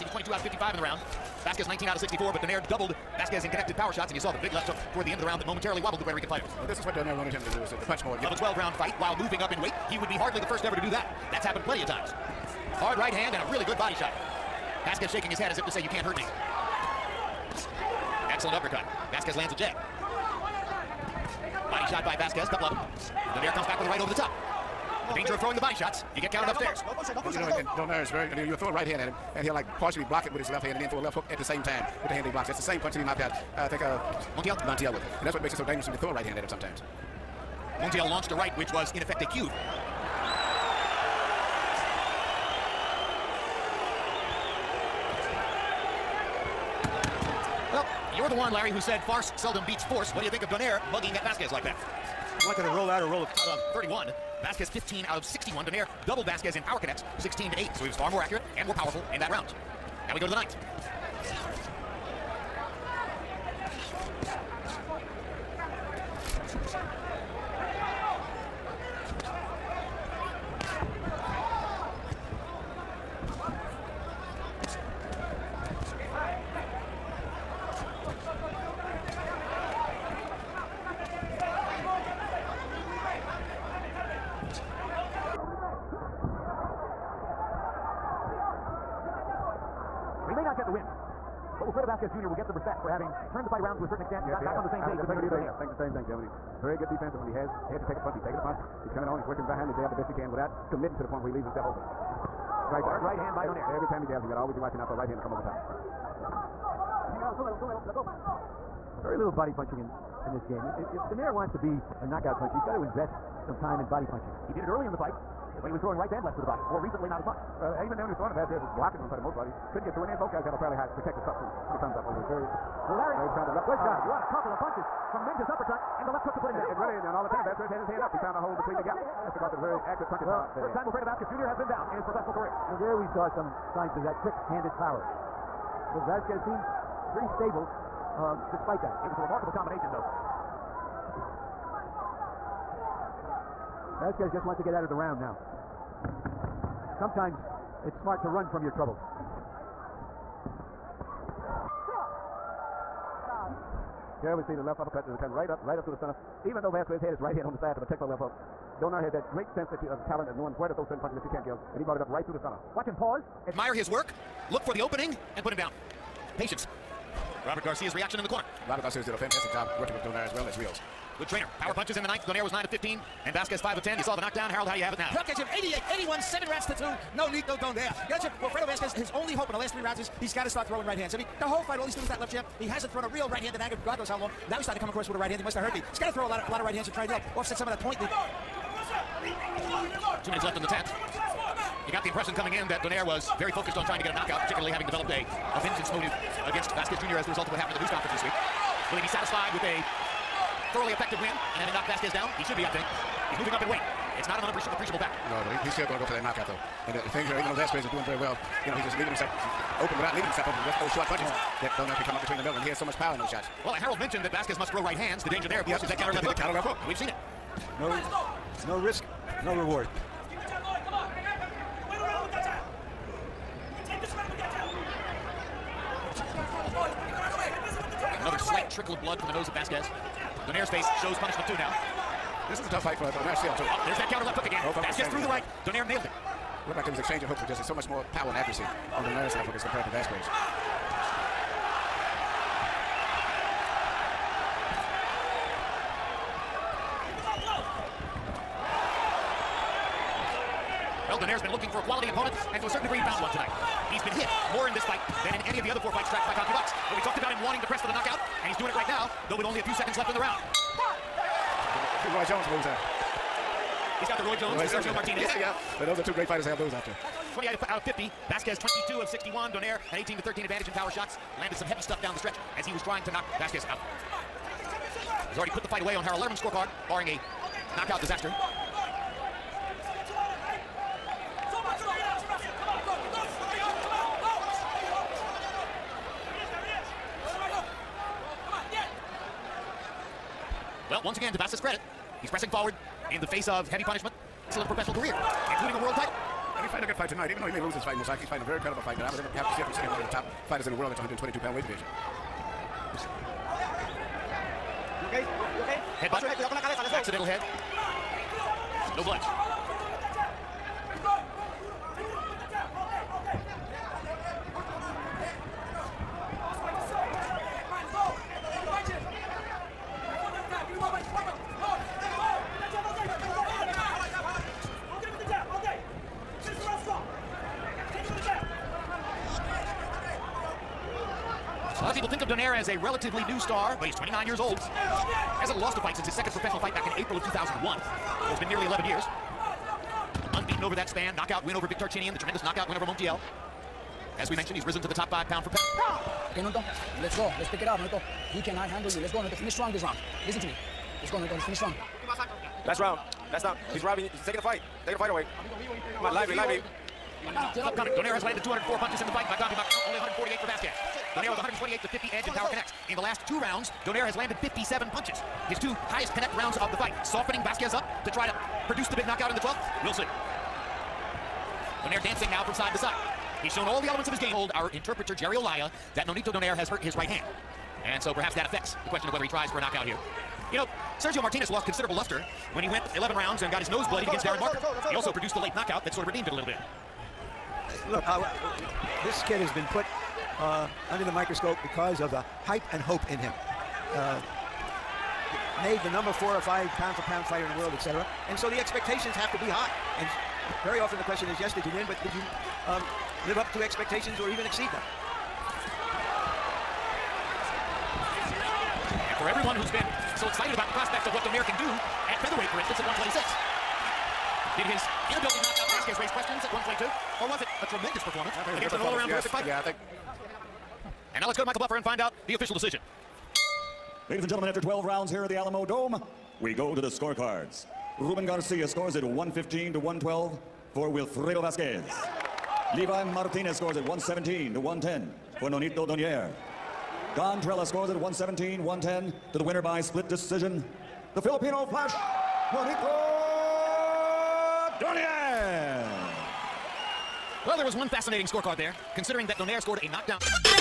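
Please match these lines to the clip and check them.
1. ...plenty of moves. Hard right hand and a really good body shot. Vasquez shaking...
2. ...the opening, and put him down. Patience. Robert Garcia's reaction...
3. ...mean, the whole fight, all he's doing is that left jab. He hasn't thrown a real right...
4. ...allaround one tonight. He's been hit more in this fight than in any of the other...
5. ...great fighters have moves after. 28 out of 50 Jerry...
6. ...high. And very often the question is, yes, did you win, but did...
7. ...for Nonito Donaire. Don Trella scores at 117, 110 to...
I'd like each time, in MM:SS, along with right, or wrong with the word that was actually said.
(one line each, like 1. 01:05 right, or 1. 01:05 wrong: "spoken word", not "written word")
1. 00:11 wrong: "times", not "moves"
2. 02:44 right
3. 03:01 right
4. 04:13 wrong: "found", not "allaround"
5. 04:26 wrong: "Vasquez", not "Jerry"
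6. 06:39 right
7. 07:15 right.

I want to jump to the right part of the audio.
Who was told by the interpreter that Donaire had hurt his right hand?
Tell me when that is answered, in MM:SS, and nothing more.
06:15.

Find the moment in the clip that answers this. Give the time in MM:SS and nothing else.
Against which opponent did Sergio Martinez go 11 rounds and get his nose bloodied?
06:24.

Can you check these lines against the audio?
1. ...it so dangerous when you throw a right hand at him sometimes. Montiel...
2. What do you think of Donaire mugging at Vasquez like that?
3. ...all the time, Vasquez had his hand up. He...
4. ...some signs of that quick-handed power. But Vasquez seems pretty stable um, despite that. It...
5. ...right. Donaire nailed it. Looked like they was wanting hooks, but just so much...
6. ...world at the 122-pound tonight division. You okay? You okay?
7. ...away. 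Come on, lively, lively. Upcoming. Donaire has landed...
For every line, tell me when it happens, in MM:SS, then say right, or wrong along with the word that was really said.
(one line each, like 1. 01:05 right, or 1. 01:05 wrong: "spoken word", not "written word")
1. 00:35 right
2. 00:50 right
3. 02:07 right
4. 02:13 right
5. 03:55 wrong: "exchanging", not "wanting"
6. 05:00 wrong: "weight", not "tonight"
7. 05:55 right.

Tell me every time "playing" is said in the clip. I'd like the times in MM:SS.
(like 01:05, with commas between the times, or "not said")
not said.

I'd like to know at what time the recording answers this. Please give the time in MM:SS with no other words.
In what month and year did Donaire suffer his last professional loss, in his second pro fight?
05:37.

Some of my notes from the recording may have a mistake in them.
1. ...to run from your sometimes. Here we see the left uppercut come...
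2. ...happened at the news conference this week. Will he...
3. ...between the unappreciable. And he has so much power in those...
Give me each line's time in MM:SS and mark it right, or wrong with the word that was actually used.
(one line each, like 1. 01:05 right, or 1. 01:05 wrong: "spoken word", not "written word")
1. 02:28 wrong: "troubles", not "sometimes"
2. 03:17 right
3. 03:32 wrong: "middle", not "unappreciable".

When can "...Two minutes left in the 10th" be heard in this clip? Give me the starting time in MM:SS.
03:10.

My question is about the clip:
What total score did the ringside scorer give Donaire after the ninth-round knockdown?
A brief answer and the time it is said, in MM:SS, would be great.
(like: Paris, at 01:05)
88, at 02:55.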